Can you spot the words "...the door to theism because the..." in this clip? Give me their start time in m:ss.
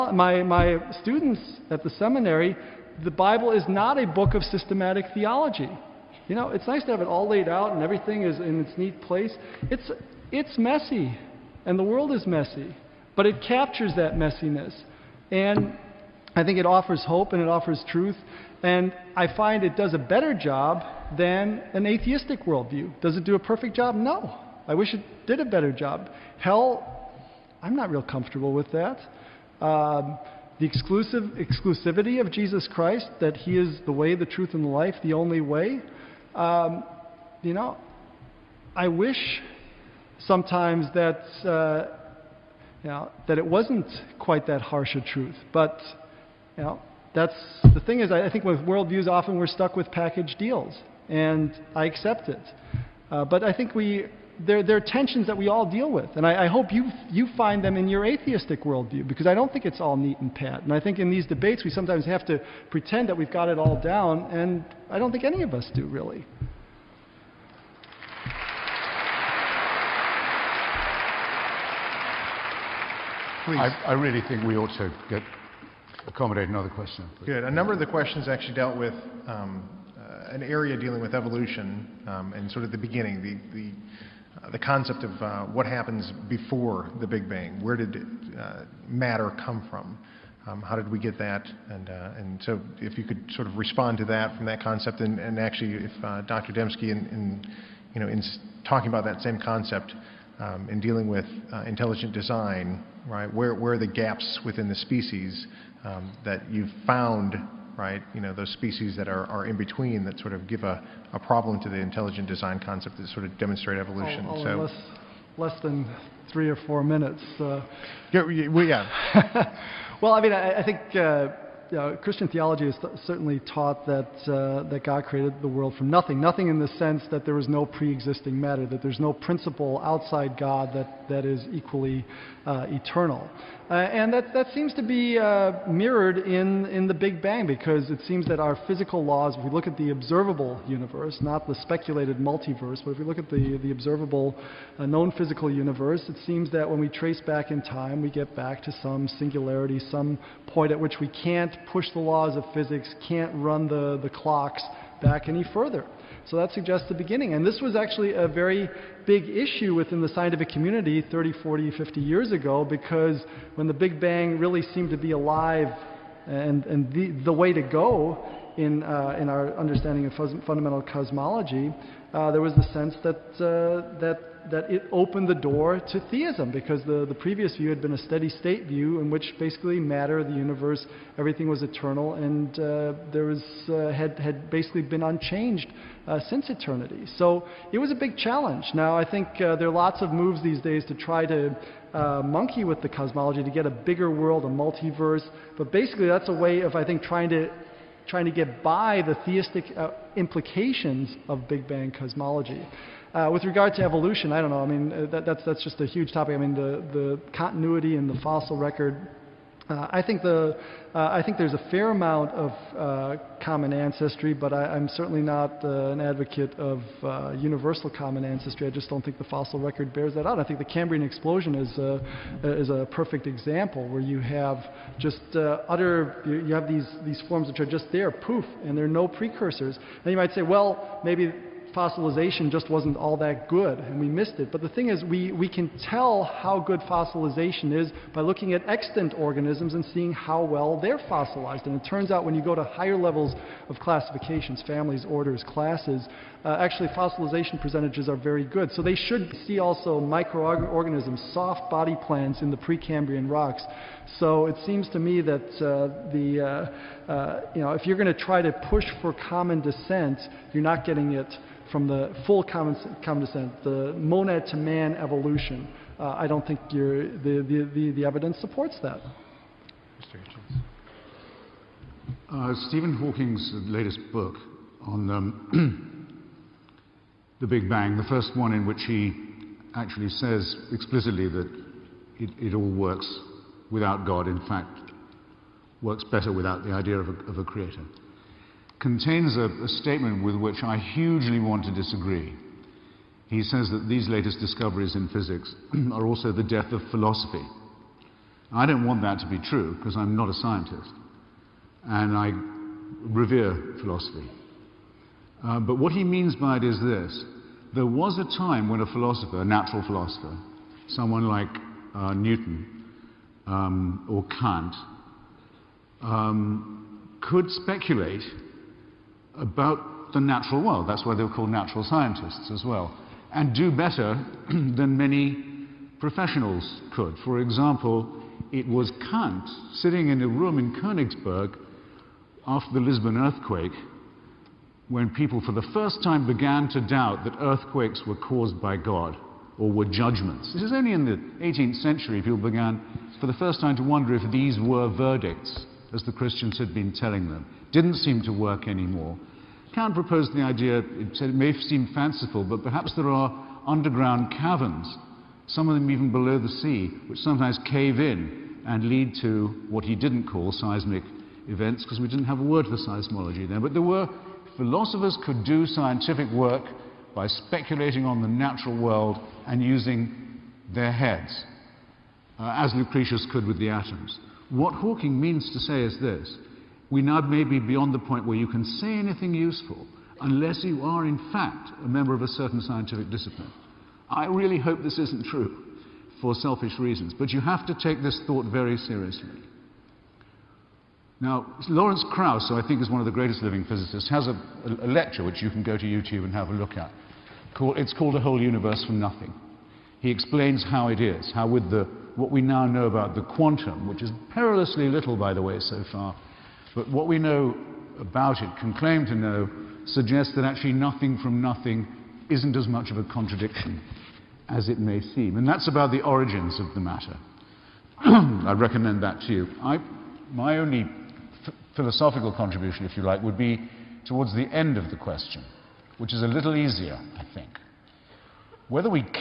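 2:55.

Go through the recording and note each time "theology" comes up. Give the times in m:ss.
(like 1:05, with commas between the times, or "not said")
0:05, 2:02.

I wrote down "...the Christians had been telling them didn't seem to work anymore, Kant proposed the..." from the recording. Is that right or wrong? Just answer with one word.
right.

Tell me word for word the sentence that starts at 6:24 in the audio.
I really hope this isn't true for selfish reasons, but you have to take this thought very seriously.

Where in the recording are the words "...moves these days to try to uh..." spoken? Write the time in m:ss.
3:10.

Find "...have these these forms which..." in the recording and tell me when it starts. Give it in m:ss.
3:46.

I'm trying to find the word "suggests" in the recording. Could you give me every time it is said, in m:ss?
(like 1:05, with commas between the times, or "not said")
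2:36, 6:49.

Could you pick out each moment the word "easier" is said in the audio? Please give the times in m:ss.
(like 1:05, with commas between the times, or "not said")
7:06.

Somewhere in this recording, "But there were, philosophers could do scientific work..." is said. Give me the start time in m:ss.
6:03.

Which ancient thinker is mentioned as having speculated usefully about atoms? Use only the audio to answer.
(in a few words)
Lucretius.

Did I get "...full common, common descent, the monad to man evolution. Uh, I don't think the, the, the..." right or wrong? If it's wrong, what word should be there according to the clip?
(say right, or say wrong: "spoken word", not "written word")
right.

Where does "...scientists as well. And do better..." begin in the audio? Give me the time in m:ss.
5:21.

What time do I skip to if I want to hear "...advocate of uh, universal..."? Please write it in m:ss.
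3:36.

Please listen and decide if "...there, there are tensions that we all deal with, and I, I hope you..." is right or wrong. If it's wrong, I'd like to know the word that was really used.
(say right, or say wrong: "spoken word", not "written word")
right.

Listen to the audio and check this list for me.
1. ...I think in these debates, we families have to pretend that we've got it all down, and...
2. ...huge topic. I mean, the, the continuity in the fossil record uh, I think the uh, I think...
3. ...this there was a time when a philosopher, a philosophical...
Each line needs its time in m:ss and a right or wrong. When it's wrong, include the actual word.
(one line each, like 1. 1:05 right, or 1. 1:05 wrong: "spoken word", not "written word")
1. 1:00 wrong: "sometimes", not "families"
2. 3:25 right
3. 5:06 wrong: "natural", not "philosophical".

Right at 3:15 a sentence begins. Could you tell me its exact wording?
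But basically, that's a way of, I think, trying to trying to get by the theistic uh, implications of Big Bang cosmology.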